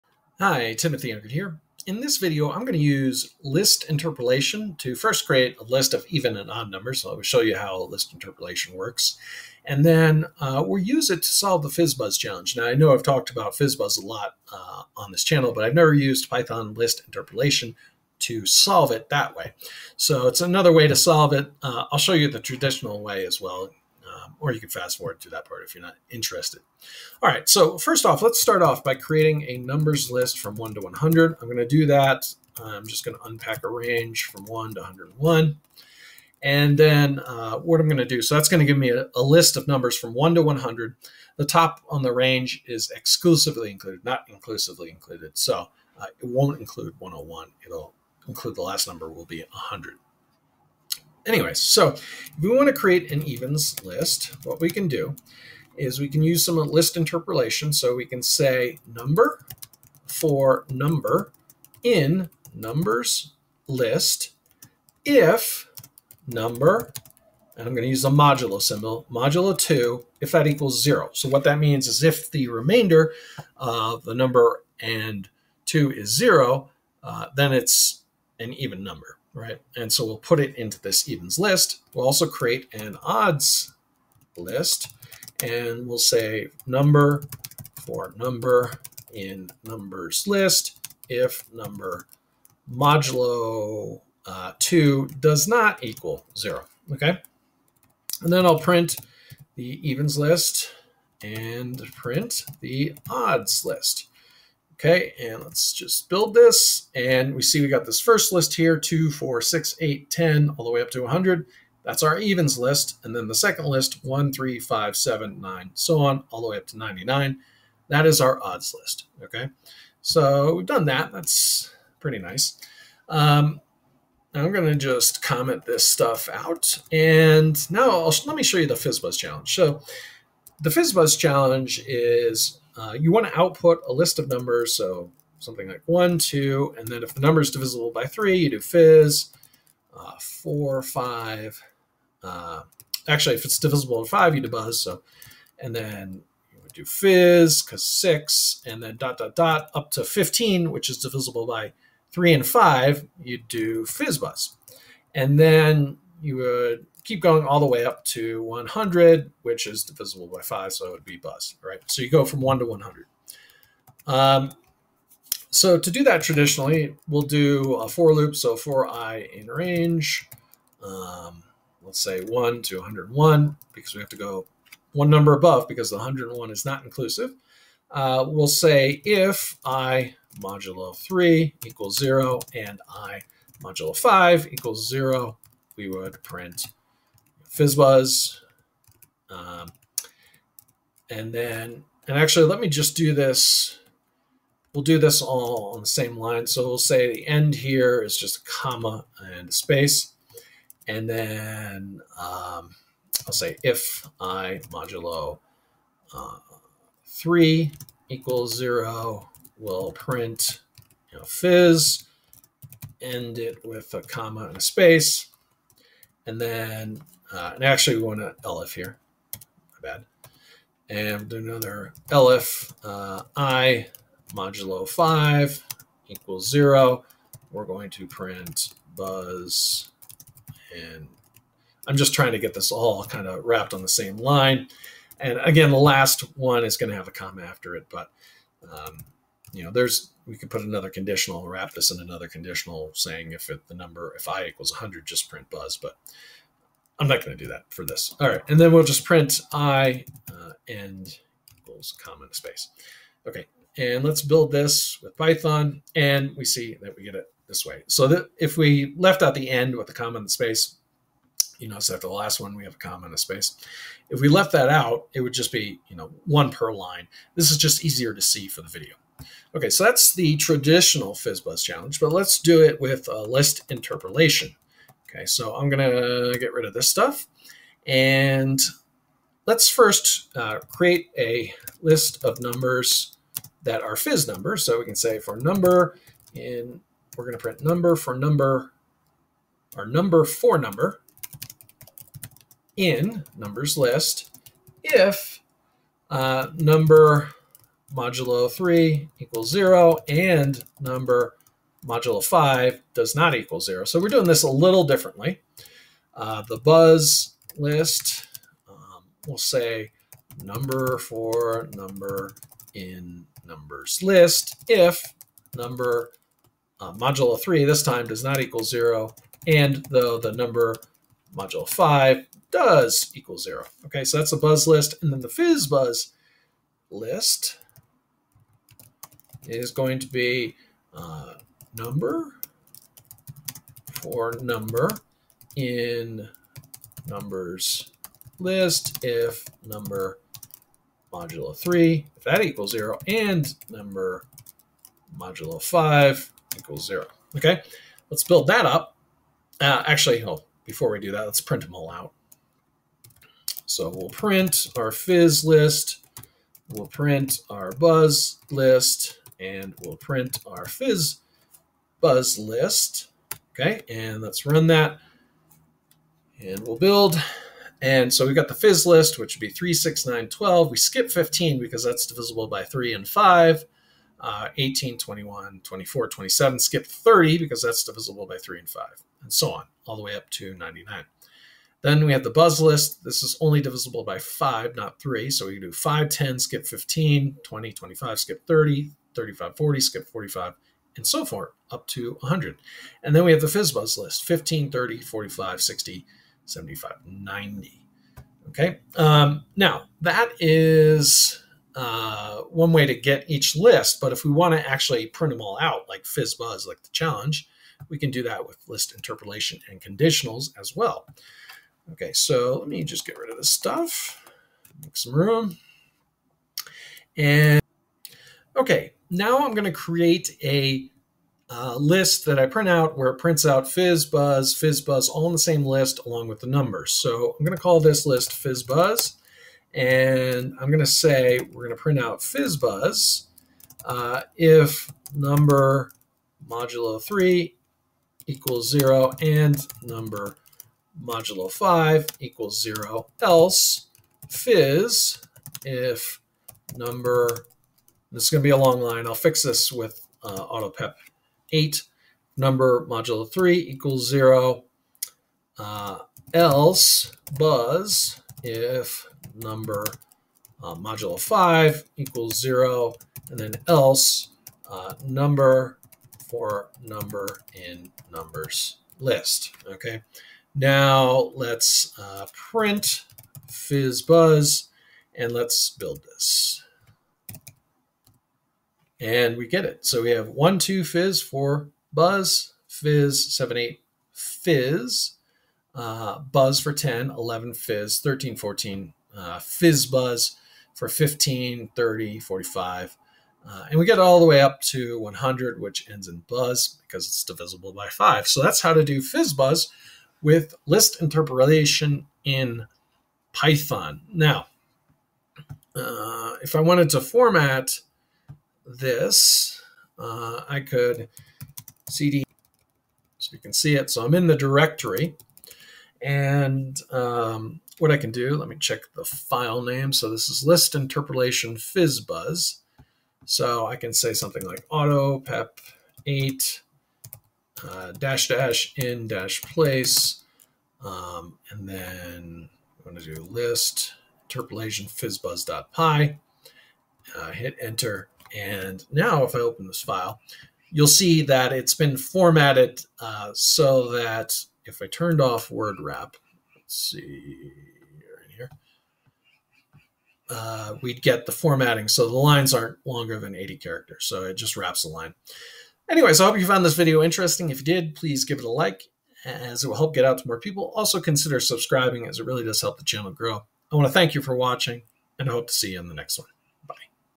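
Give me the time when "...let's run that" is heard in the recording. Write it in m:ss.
6:04.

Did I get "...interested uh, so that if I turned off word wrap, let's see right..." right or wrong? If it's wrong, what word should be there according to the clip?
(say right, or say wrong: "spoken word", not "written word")
wrong: "formatted", not "interested".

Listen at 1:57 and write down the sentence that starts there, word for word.
That is our odds list, okay?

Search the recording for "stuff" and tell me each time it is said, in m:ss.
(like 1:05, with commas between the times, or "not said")
2:05, 4:36, 6:53.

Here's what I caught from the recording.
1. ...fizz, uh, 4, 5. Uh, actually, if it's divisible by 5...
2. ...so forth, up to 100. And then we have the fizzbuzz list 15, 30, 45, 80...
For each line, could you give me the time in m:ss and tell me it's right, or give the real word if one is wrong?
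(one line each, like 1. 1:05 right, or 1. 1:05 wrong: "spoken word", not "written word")
1. 2:18 right
2. 6:31 wrong: "60", not "80".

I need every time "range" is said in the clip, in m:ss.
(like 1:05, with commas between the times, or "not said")
0:33, 0:42, 2:49.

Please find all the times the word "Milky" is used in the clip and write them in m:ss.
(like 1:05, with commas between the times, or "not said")
not said.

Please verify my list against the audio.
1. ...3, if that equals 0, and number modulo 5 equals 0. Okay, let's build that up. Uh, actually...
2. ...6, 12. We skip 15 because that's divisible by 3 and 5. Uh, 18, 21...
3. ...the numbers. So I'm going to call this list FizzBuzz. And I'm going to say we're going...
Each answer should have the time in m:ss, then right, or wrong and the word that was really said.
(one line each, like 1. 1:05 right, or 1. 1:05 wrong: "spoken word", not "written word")
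1. 5:41 right
2. 6:10 wrong: "9", not "6"
3. 7:06 right.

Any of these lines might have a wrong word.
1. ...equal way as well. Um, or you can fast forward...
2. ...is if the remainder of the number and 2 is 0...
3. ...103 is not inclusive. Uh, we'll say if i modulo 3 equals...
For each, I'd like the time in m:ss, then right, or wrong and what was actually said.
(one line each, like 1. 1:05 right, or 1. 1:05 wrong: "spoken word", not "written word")
1. 0:22 wrong: "traditional", not "equal"
2. 1:11 right
3. 2:55 wrong: "101", not "103".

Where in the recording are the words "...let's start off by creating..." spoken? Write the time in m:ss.
0:28.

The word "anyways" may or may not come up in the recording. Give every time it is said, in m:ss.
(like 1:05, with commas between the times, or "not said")
0:51, 9:15.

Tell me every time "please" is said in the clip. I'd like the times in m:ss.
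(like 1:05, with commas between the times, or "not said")
9:17.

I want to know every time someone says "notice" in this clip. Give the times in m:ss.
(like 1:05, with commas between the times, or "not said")
4:21.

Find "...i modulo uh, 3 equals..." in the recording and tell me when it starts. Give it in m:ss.
3:24.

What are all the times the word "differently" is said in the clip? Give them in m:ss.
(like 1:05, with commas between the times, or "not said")
5:04.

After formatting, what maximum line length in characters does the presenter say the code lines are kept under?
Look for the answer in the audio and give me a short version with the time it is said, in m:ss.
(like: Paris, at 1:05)
80, at 9:13.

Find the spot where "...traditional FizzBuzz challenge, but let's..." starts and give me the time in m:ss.
4:30.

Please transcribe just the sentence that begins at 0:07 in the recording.
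So I'll show you how list interpolation works.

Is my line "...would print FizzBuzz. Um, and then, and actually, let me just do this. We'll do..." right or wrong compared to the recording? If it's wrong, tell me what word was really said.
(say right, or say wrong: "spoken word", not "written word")
right.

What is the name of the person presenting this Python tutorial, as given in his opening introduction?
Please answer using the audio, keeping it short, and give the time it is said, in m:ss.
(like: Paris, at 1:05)
Timothy Unkert, at 0:00.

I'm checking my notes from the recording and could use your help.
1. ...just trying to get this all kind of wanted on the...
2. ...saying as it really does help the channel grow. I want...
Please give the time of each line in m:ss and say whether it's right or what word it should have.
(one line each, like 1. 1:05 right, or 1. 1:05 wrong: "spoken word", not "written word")
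1. 3:51 wrong: "wrapped", not "wanted"
2. 9:21 wrong: "subscribing", not "saying".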